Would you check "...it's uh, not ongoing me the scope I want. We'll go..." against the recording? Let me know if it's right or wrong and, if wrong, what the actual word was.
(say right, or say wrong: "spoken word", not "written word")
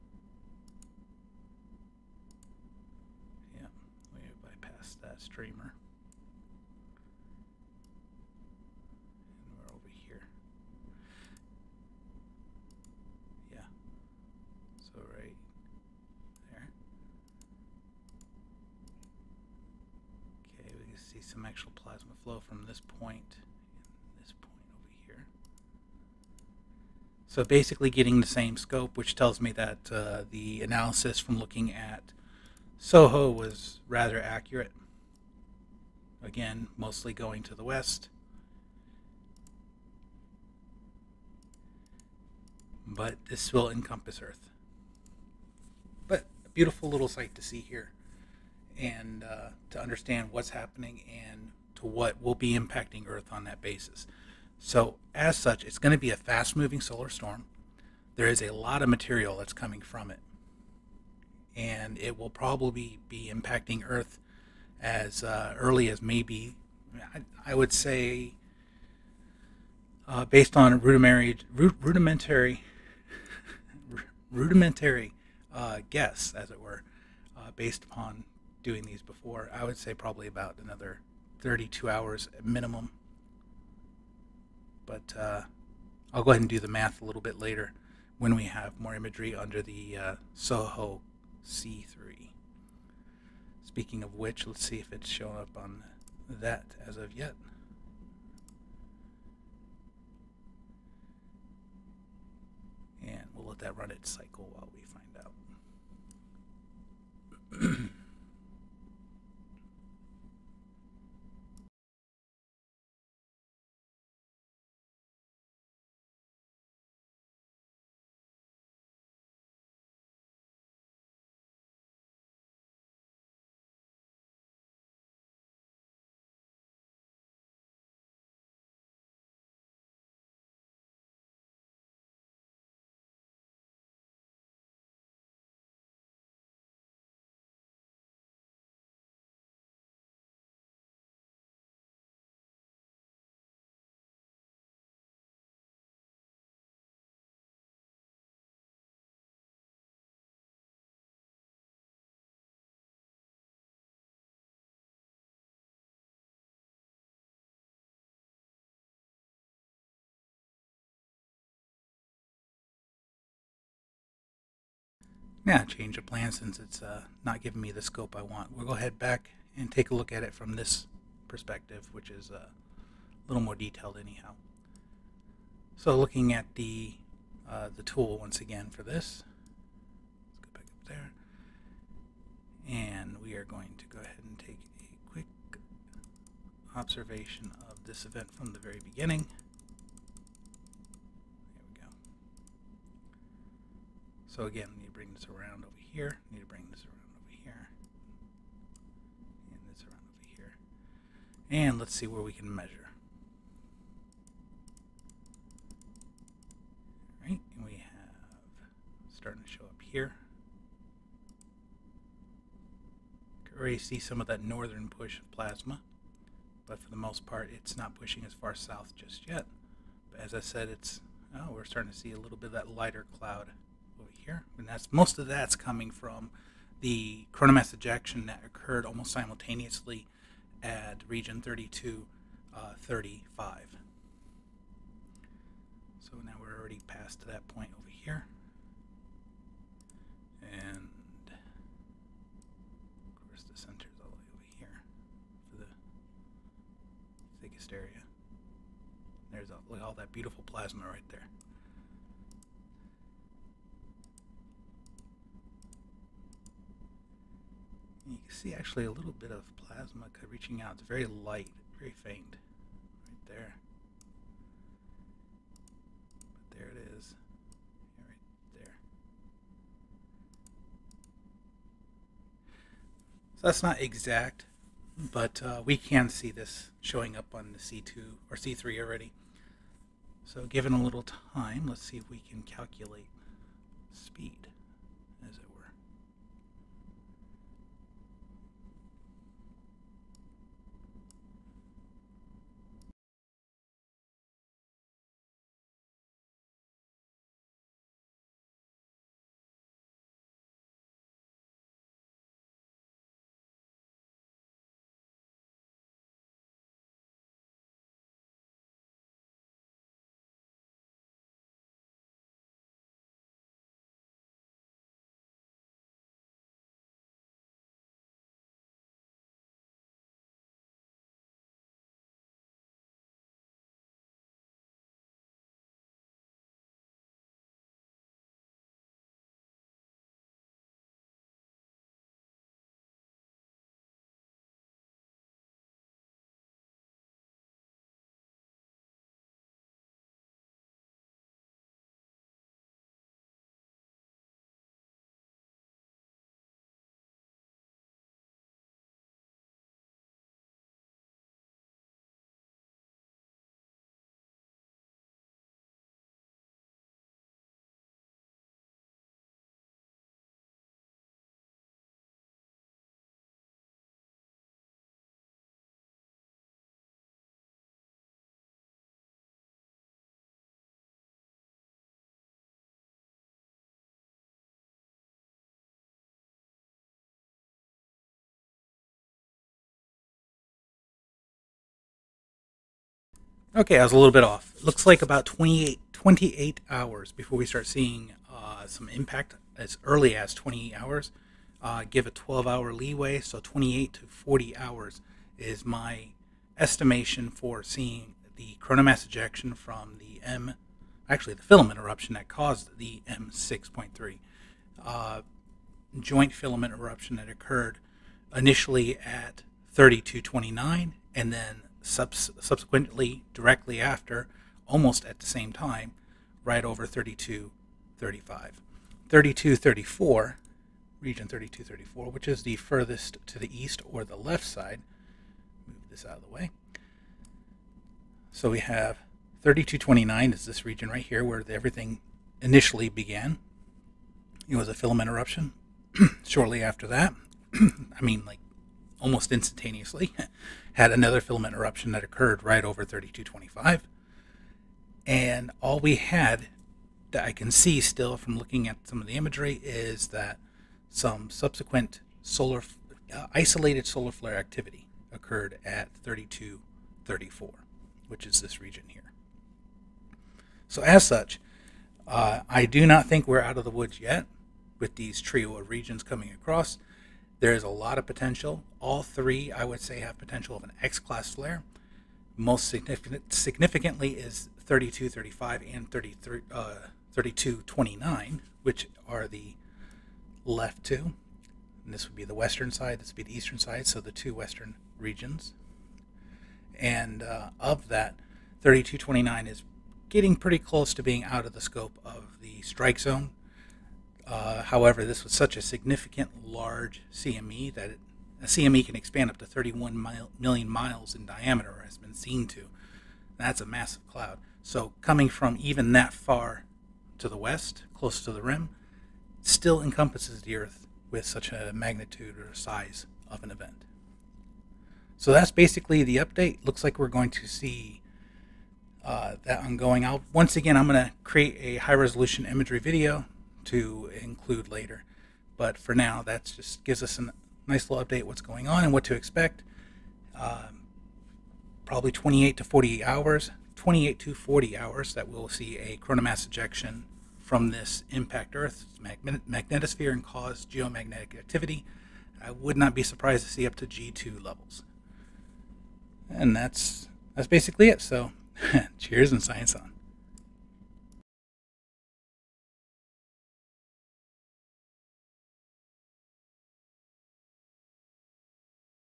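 wrong: "giving", not "ongoing".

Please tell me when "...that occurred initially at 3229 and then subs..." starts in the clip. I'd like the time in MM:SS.
06:47.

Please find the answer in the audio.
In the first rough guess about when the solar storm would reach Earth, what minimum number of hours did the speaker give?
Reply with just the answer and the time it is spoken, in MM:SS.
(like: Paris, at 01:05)
32 hours, at 01:21.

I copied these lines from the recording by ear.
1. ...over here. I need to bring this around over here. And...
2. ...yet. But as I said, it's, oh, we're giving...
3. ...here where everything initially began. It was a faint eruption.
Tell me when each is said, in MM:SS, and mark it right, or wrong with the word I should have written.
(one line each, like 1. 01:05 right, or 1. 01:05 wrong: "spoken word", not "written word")
1. 03:15 right
2. 03:39 wrong: "starting", not "giving"
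3. 07:11 wrong: "filament", not "faint".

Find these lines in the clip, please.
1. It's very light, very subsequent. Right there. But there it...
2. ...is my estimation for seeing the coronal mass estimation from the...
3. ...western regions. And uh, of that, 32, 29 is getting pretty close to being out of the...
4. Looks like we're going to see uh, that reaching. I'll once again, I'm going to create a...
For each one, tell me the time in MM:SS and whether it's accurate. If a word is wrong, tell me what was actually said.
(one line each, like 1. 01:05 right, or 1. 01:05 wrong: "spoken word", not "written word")
1. 04:20 wrong: "faint", not "subsequent"
2. 06:35 wrong: "ejection", not "estimation"
3. 08:04 right
4. 08:36 wrong: "ongoing", not "reaching".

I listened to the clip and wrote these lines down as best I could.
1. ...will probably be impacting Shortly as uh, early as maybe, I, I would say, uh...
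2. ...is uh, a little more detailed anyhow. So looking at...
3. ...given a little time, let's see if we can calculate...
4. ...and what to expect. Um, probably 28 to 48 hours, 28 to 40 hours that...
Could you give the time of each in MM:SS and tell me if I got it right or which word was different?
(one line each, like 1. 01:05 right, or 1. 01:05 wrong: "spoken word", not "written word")
1. 01:02 wrong: "Earth", not "Shortly"
2. 02:52 right
3. 04:40 right
4. 08:48 right.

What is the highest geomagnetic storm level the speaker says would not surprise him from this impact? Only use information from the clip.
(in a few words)
G2.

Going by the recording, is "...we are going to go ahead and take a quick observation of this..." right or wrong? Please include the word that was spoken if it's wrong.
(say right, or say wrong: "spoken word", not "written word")
right.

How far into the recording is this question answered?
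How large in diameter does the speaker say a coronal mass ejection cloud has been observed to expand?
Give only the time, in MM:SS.
08:19.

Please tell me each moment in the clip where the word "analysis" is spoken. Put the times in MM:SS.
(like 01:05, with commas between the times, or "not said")
00:30.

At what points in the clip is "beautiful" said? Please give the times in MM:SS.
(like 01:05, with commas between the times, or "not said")
00:46, 04:10.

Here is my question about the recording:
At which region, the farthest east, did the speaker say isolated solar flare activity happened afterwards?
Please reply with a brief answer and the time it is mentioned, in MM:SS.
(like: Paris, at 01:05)
3234, at 07:36.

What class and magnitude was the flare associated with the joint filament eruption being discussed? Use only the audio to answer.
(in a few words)
M6.3.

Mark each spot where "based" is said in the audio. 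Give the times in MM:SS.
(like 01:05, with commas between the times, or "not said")
01:10, 01:17.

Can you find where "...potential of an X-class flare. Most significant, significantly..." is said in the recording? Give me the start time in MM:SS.
07:50.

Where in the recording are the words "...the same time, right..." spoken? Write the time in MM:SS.
06:55.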